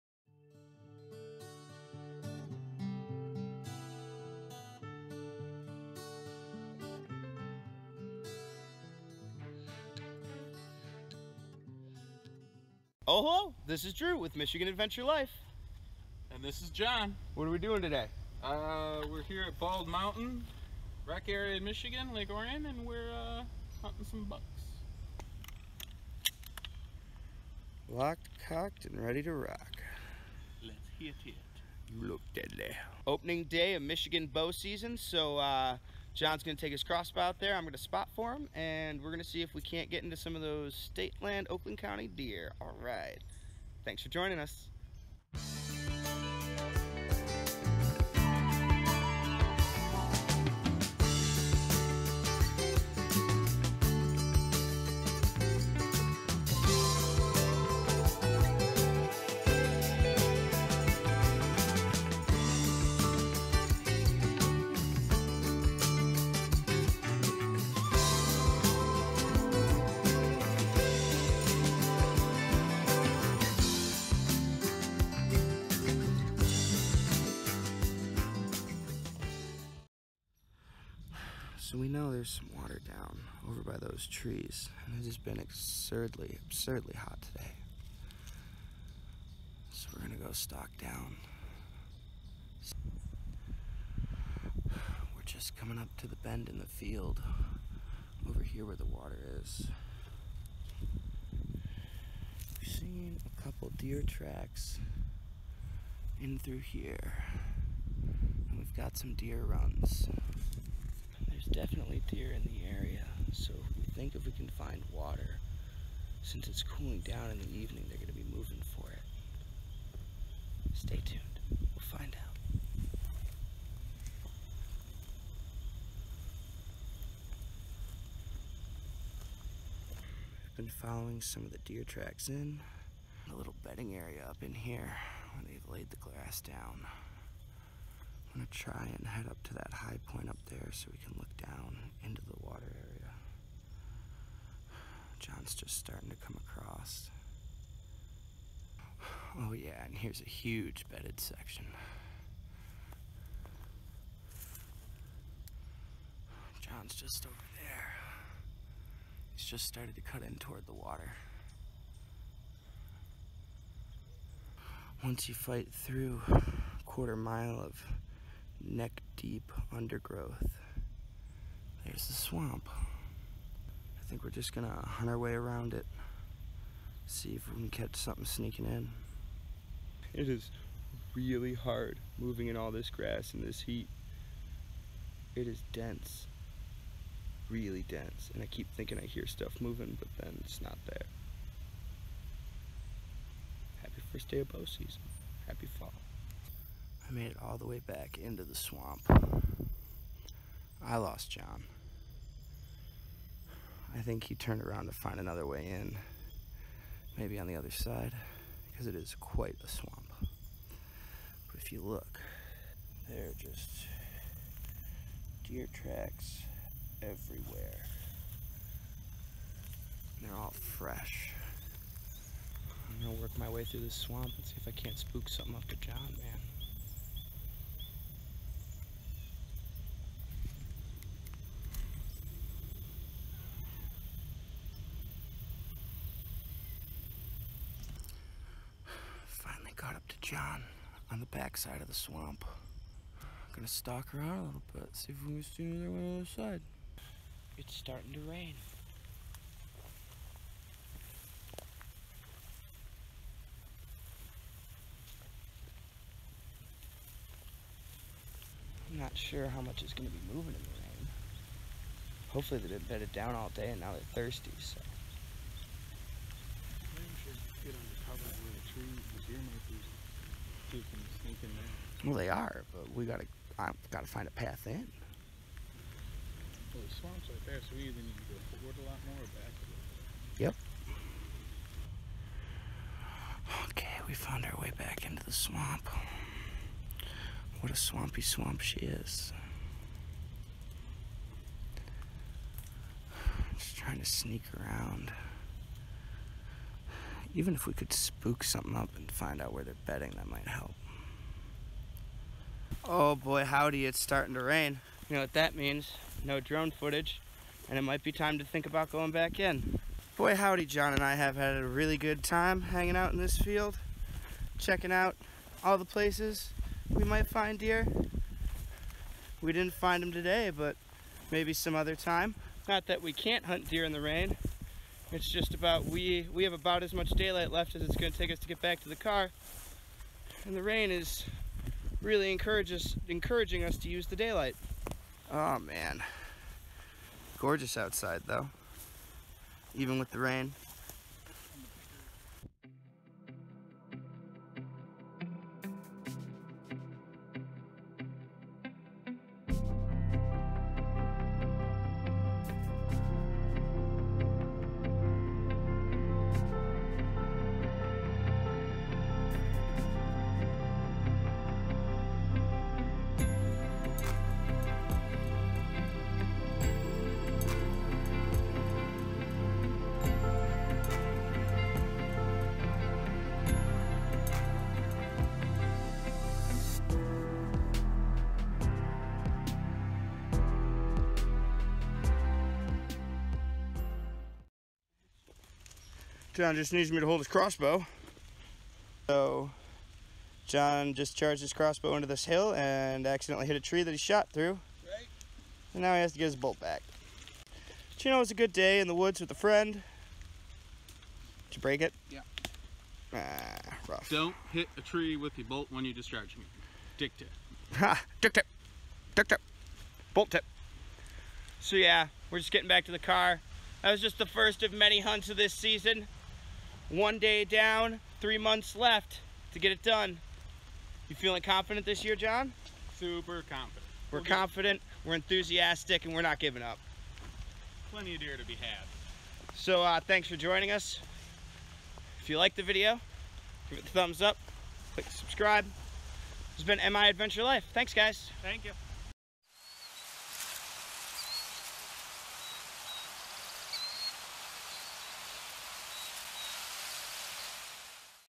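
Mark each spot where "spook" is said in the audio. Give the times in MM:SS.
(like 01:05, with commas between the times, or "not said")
03:44, 04:57.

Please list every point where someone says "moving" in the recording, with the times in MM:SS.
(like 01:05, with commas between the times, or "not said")
01:58, 03:02, 03:09, 04:20.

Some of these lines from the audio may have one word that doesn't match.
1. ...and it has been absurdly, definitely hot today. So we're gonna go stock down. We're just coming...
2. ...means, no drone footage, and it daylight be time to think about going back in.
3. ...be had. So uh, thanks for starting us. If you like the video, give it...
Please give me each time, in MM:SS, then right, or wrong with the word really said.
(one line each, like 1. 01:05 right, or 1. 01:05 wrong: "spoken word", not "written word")
1. 01:24 wrong: "absurdly", not "definitely"
2. 05:05 wrong: "might", not "daylight"
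3. 07:08 wrong: "joining", not "starting".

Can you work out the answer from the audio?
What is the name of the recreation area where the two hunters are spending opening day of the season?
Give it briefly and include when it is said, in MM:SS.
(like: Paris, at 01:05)
Bald Mountain, at 00:19.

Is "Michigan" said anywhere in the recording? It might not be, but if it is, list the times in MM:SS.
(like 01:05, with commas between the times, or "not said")
00:14, 00:21, 00:33.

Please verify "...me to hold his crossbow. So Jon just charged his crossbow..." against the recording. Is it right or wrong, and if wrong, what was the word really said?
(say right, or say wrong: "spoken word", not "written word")
right.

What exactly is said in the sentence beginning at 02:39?
He's just started to cut in toward the water.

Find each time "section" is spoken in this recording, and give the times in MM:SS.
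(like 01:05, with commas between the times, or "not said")
02:31.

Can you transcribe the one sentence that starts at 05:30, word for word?
And the rain is really encourages encouraging us to use the daylight.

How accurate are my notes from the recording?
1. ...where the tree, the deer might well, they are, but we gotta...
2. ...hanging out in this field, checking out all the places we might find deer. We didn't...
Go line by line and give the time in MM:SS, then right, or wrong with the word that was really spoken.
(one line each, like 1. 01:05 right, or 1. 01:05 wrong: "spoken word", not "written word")
1. 04:28 right
2. 05:12 right.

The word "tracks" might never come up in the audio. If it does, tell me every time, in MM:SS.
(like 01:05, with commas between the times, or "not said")
01:44, 02:11, 03:35.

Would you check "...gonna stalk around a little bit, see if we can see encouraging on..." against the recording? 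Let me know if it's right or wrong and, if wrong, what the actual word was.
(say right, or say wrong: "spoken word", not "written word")
wrong: "anything", not "encouraging".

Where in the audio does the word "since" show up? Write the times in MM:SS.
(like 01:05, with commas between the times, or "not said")
01:56.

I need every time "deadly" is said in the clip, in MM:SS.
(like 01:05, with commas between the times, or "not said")
00:32.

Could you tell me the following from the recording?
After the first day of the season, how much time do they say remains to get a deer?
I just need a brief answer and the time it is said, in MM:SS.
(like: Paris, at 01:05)
3 months, at 06:58.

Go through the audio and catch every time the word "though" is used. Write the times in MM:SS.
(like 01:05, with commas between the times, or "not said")
05:38.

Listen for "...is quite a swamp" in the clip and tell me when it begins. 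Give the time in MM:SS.
03:28.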